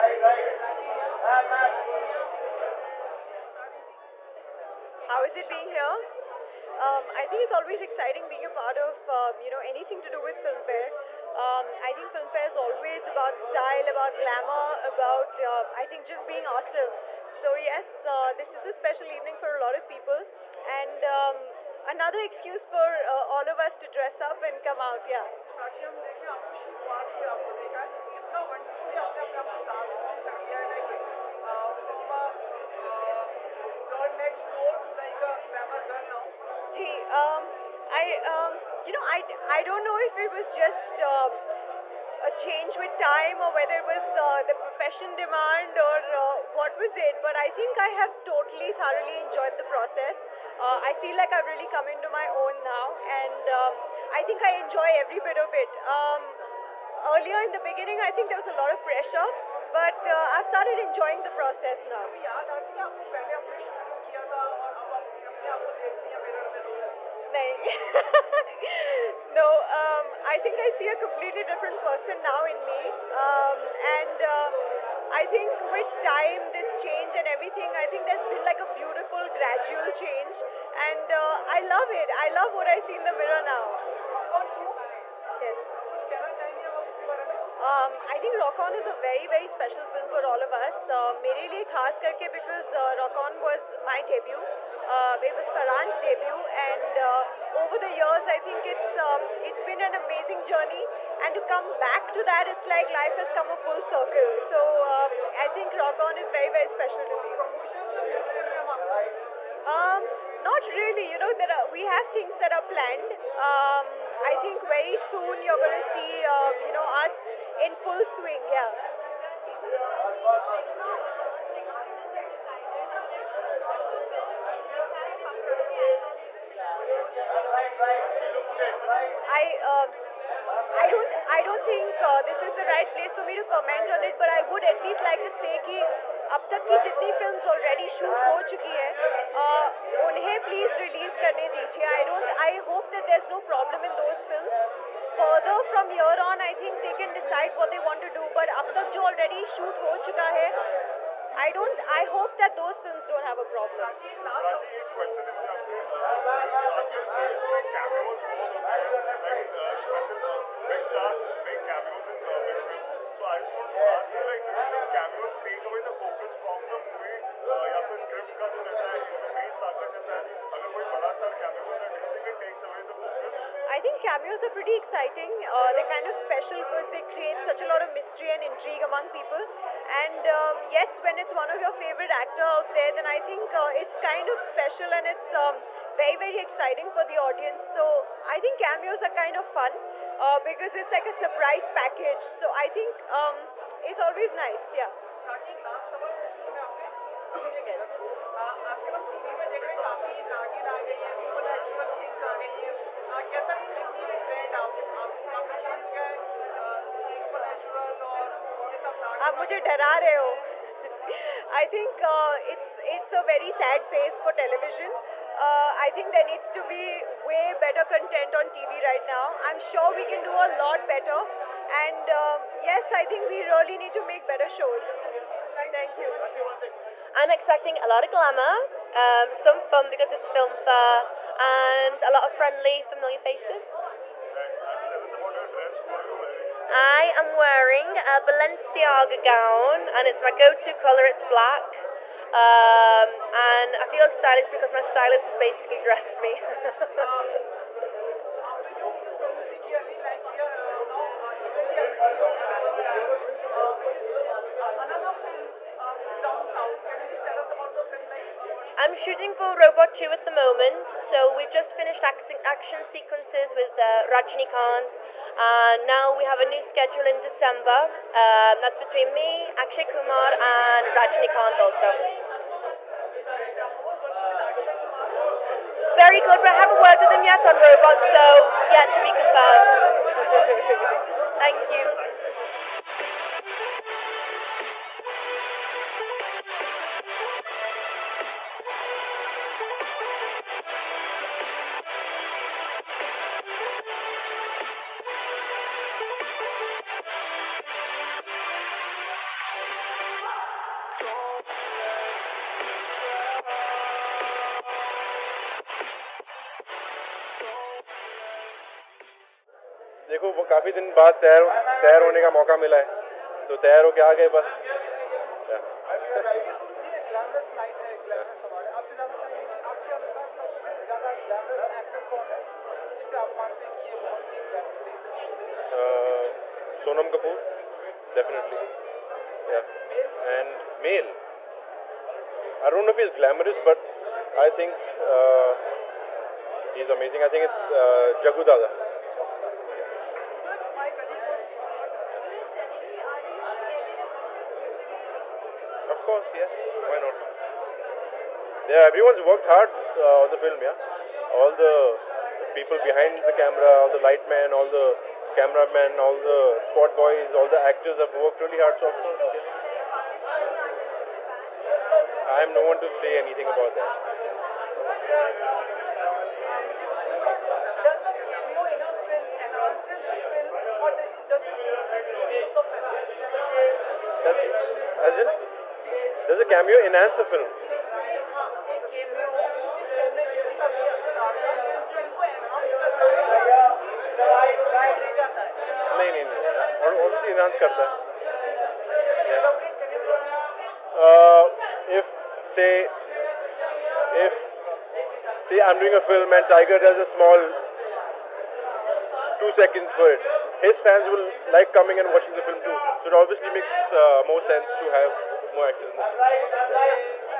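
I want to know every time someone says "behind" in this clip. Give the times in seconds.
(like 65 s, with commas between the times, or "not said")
352 s.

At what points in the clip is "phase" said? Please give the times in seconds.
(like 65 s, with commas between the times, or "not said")
213 s.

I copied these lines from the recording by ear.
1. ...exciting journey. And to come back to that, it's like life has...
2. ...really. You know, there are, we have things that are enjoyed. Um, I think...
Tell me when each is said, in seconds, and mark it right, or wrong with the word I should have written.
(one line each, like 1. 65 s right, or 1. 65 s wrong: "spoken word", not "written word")
1. 100 s wrong: "amazing", not "exciting"
2. 110 s wrong: "planned", not "enjoyed".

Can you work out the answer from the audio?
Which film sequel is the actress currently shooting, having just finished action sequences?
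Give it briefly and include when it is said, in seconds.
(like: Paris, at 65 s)
Robot 2, at 259 s.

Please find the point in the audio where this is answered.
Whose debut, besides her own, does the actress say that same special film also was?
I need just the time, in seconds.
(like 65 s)
95 s.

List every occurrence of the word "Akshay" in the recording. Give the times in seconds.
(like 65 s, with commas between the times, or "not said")
269 s.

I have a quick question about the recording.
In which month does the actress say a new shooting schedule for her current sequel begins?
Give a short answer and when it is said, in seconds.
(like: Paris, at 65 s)
December, at 267 s.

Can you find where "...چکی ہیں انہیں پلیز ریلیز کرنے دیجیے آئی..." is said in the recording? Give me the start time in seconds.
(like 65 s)
138 s.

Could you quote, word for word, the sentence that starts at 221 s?
And uh, yes, I think we really need to make better shows.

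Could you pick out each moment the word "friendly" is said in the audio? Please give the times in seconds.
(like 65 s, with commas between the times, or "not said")
232 s.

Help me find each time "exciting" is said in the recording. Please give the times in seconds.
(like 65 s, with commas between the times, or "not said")
7 s, 174 s, 186 s.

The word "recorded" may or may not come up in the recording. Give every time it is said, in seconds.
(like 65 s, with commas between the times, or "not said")
not said.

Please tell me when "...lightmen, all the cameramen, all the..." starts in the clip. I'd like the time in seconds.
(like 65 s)
353 s.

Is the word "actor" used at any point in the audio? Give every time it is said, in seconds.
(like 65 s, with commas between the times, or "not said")
182 s, 357 s.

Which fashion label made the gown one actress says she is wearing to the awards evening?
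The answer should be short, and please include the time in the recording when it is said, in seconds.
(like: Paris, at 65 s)
Balenciaga, at 238 s.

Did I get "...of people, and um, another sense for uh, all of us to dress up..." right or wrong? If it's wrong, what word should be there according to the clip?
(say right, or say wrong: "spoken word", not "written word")
wrong: "excuse", not "sense".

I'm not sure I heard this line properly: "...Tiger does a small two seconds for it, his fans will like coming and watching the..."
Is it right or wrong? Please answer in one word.
right.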